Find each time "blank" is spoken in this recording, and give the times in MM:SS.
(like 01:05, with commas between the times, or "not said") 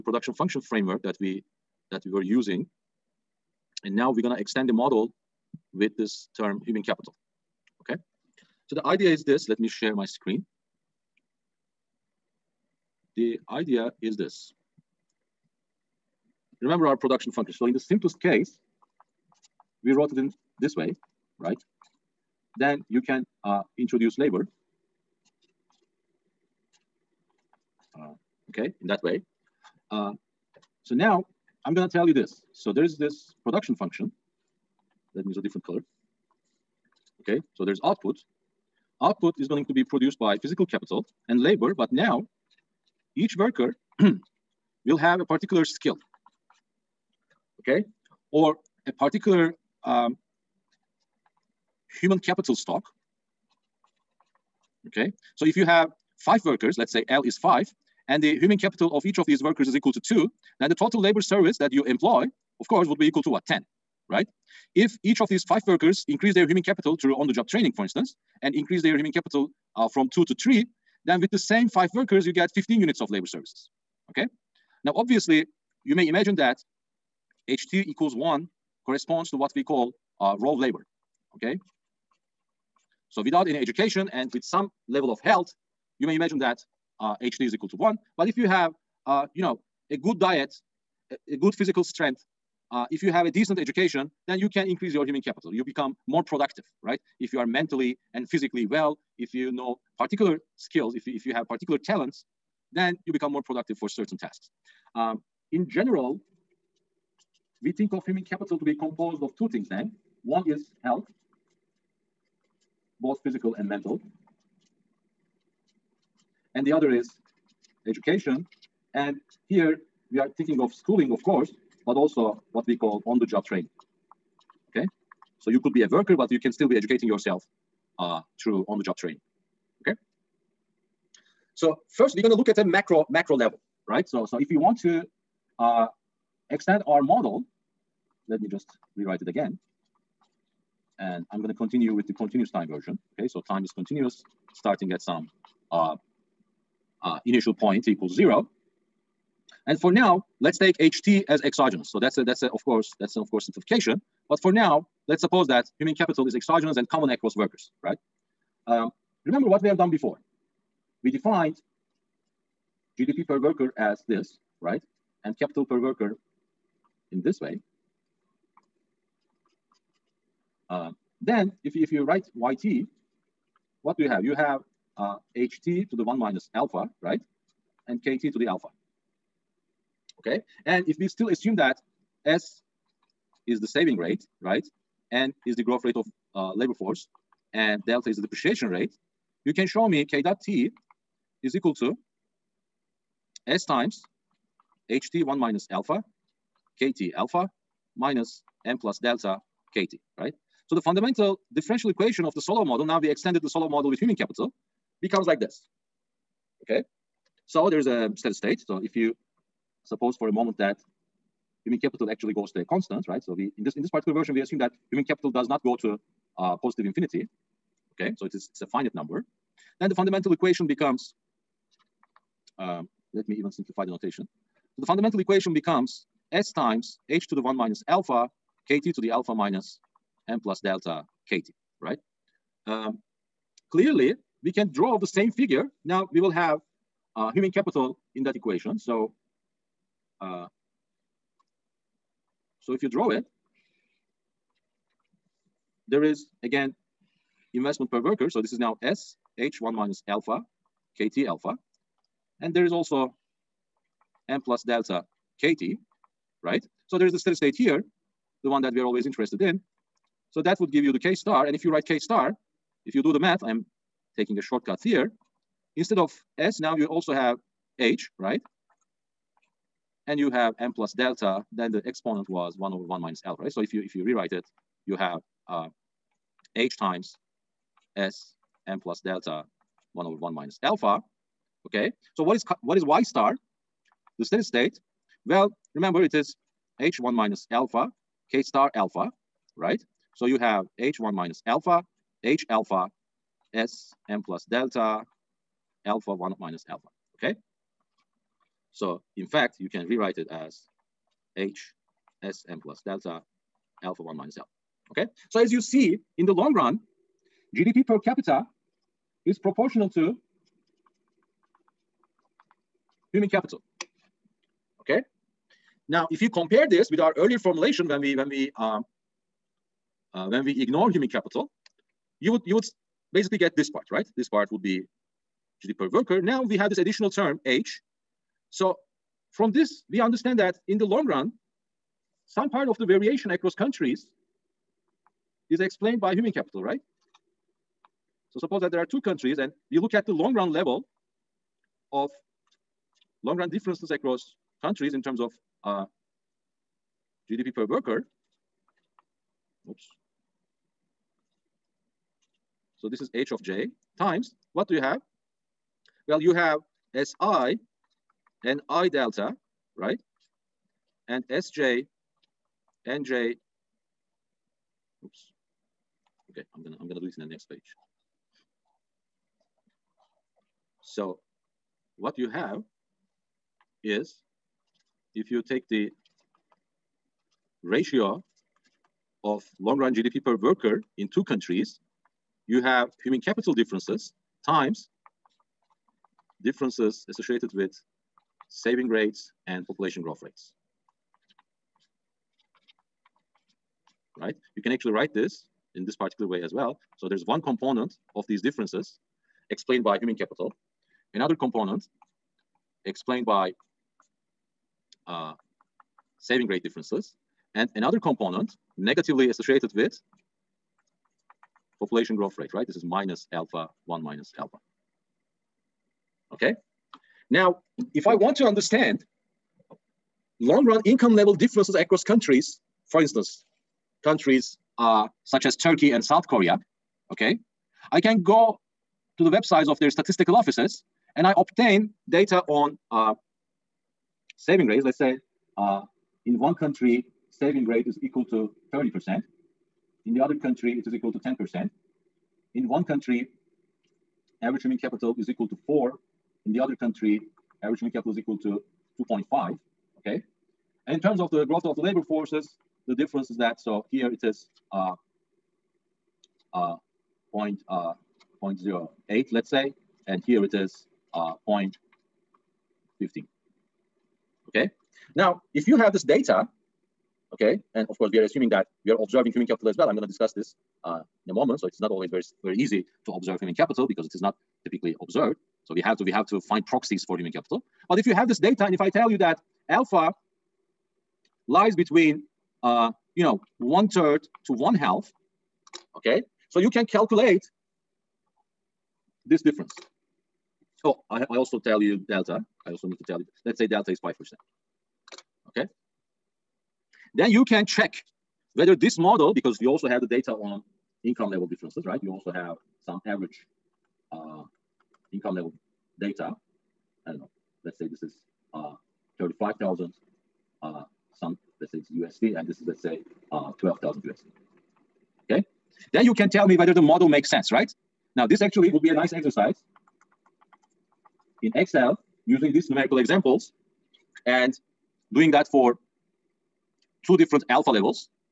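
not said.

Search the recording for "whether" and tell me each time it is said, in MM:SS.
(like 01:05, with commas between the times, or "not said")
08:18, 08:36.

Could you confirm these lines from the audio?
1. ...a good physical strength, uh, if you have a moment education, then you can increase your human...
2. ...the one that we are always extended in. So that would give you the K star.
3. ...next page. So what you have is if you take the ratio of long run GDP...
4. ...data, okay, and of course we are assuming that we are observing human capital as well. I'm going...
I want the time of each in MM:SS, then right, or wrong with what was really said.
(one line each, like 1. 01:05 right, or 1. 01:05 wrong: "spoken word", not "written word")
1. 01:31 wrong: "decent", not "moment"
2. 04:18 wrong: "interested", not "extended"
3. 06:07 right
4. 07:46 right.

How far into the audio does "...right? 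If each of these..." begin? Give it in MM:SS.
01:04.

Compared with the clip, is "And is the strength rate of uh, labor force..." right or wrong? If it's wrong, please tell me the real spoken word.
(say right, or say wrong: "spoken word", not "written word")
wrong: "growth", not "strength".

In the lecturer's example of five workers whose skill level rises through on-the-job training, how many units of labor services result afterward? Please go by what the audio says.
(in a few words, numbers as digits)
15.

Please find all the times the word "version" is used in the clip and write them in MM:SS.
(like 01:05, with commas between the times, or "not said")
02:22, 03:34.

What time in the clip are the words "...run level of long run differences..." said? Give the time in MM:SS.
05:40.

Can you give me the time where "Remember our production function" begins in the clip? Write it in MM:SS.
00:16.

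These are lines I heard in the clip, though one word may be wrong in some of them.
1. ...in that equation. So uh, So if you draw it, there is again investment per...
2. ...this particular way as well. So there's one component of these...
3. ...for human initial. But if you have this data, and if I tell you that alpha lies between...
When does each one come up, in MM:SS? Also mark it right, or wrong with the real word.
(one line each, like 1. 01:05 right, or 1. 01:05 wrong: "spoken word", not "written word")
1. 03:58 right
2. 06:35 right
3. 07:57 wrong: "capital", not "initial".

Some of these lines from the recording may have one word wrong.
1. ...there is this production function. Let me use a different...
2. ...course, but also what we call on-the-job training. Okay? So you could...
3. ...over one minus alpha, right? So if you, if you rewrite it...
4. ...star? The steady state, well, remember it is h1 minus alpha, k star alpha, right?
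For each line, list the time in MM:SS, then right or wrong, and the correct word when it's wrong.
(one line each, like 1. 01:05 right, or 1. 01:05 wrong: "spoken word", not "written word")
1. 00:32 right
2. 02:01 right
3. 04:32 right
4. 04:43 right.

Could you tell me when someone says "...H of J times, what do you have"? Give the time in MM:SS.
05:53.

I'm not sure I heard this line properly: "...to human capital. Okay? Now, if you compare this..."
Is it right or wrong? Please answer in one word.
right.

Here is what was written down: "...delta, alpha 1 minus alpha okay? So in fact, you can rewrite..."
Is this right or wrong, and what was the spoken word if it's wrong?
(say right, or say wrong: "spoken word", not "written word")
right.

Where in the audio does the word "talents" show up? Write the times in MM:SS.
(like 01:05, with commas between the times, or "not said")
01:41.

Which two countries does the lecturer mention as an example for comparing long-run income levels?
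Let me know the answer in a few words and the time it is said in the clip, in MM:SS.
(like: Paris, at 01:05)
Turkey and South Korea, at 07:05.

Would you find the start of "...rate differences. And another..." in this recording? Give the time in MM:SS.
06:46.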